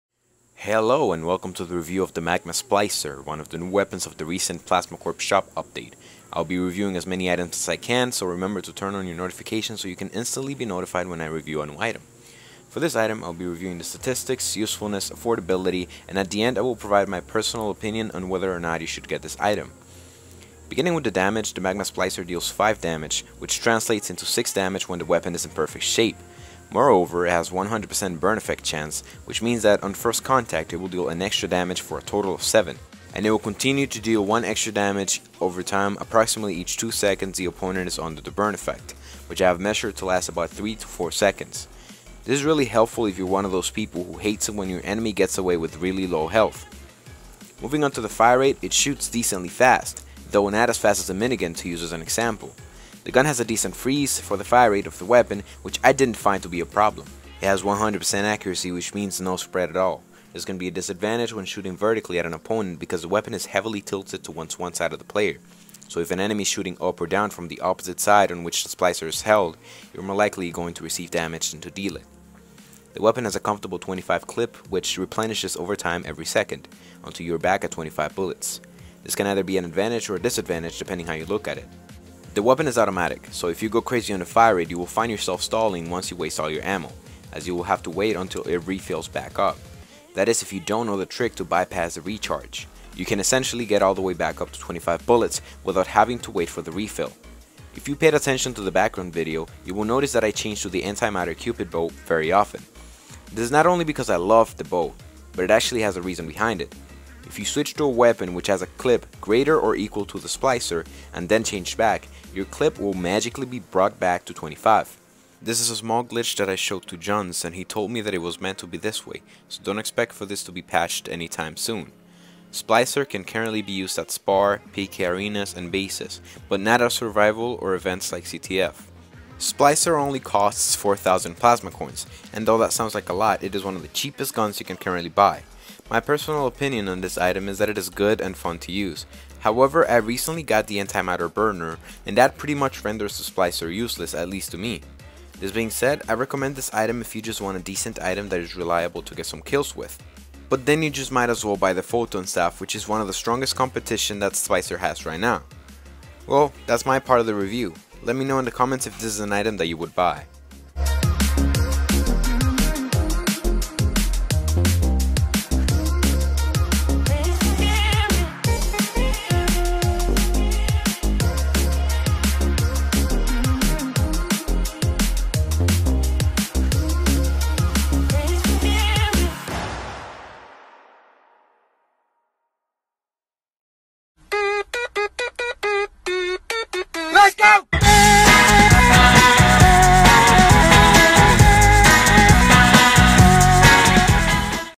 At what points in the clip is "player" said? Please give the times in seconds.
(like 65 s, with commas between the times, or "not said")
65 s.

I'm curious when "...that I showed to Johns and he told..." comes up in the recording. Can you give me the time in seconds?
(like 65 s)
116 s.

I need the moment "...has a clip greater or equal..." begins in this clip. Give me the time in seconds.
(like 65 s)
108 s.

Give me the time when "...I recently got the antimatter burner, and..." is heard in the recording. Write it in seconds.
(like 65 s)
139 s.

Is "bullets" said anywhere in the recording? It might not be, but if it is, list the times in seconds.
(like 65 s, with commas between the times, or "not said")
78 s, 95 s.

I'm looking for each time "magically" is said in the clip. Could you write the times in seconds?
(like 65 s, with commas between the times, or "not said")
112 s.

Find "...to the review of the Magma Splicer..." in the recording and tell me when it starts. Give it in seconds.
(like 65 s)
1 s.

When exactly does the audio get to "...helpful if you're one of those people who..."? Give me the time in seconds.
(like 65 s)
42 s.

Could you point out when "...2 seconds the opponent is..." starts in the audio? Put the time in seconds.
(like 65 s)
36 s.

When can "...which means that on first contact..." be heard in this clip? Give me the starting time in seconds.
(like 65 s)
29 s.